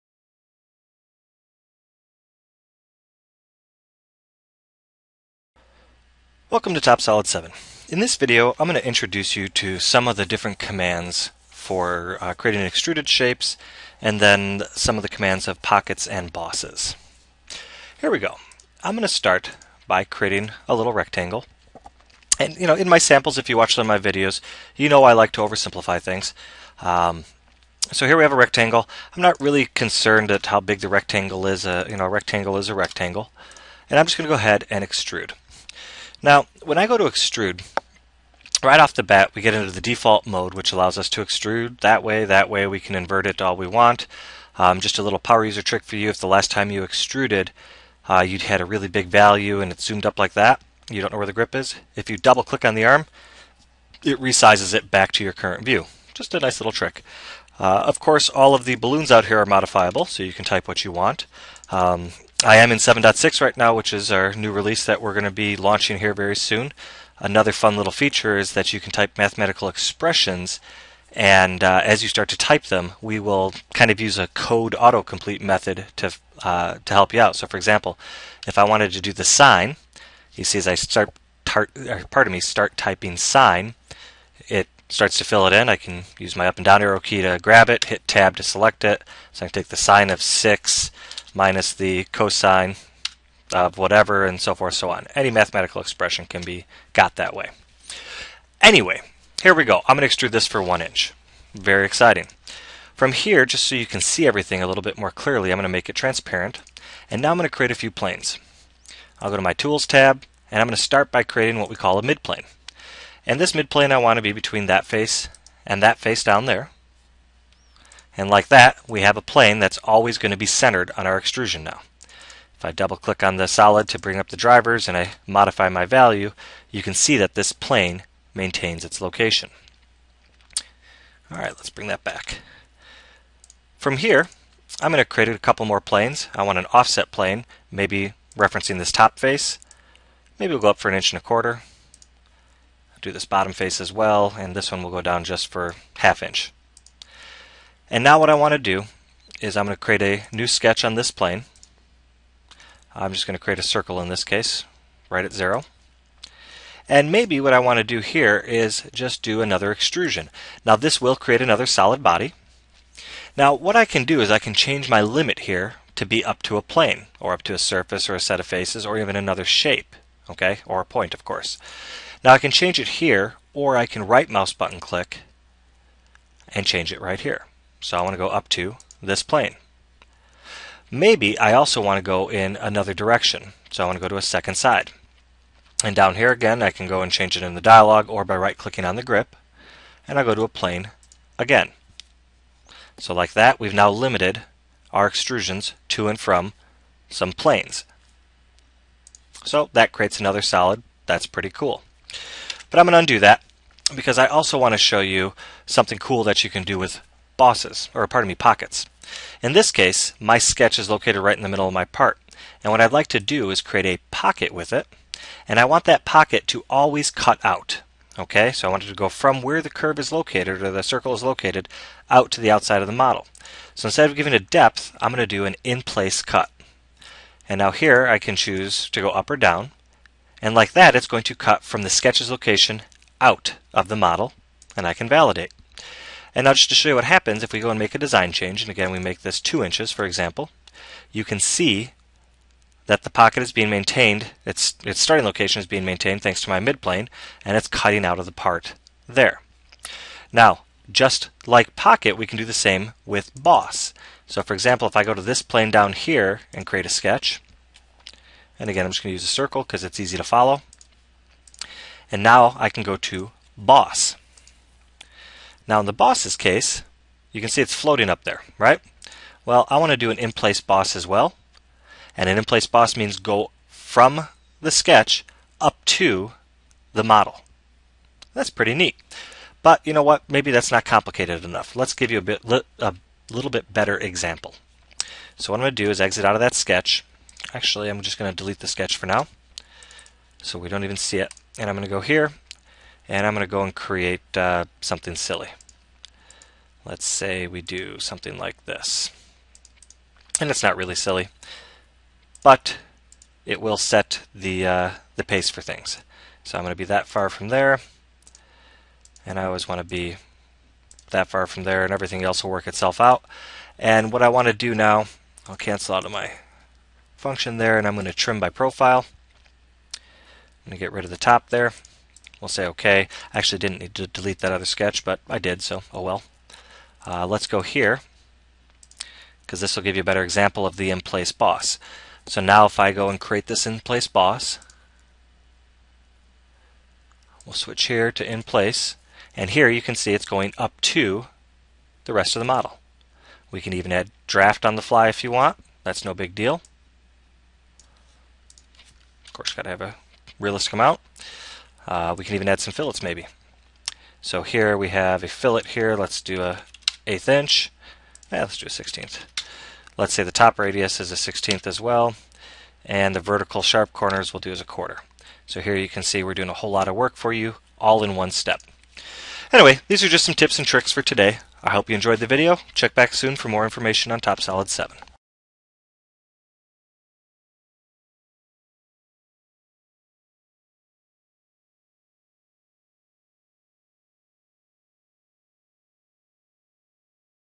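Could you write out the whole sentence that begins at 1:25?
I can use my up and down arrow key to grab it, hit tab to select it.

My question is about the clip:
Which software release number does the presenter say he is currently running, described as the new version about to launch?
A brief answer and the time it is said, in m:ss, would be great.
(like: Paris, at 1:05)
7.6, at 1:02.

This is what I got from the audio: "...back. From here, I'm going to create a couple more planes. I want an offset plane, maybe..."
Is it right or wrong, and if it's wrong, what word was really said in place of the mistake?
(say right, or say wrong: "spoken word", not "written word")
right.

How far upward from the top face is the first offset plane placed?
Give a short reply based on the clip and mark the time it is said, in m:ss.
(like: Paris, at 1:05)
an inch and a quarter, at 2:20.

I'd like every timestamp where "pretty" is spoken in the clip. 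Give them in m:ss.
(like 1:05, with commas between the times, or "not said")
3:21, 4:38.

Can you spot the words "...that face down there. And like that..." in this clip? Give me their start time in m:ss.
1:55.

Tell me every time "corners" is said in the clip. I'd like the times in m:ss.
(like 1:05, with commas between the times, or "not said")
6:03.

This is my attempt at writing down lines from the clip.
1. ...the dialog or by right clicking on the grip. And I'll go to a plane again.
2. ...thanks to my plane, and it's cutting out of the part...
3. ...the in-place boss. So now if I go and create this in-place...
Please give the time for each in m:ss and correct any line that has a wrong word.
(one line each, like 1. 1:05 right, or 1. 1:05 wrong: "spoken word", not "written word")
1. 3:07 right
2. 4:06 wrong: "midplane", not "plane"
3. 5:30 right.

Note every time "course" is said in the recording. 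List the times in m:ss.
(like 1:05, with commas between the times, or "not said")
0:57, 2:51, 5:49.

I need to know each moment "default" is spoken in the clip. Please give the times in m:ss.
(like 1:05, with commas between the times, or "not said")
0:39.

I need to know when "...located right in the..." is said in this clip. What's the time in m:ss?
3:30.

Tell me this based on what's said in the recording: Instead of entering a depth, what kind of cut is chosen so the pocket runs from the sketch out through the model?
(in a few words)
in-place cut.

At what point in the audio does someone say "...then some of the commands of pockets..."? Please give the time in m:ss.
0:14.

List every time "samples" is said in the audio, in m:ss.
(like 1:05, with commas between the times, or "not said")
0:22.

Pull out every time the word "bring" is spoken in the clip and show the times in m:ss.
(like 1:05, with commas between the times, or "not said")
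2:03, 2:11.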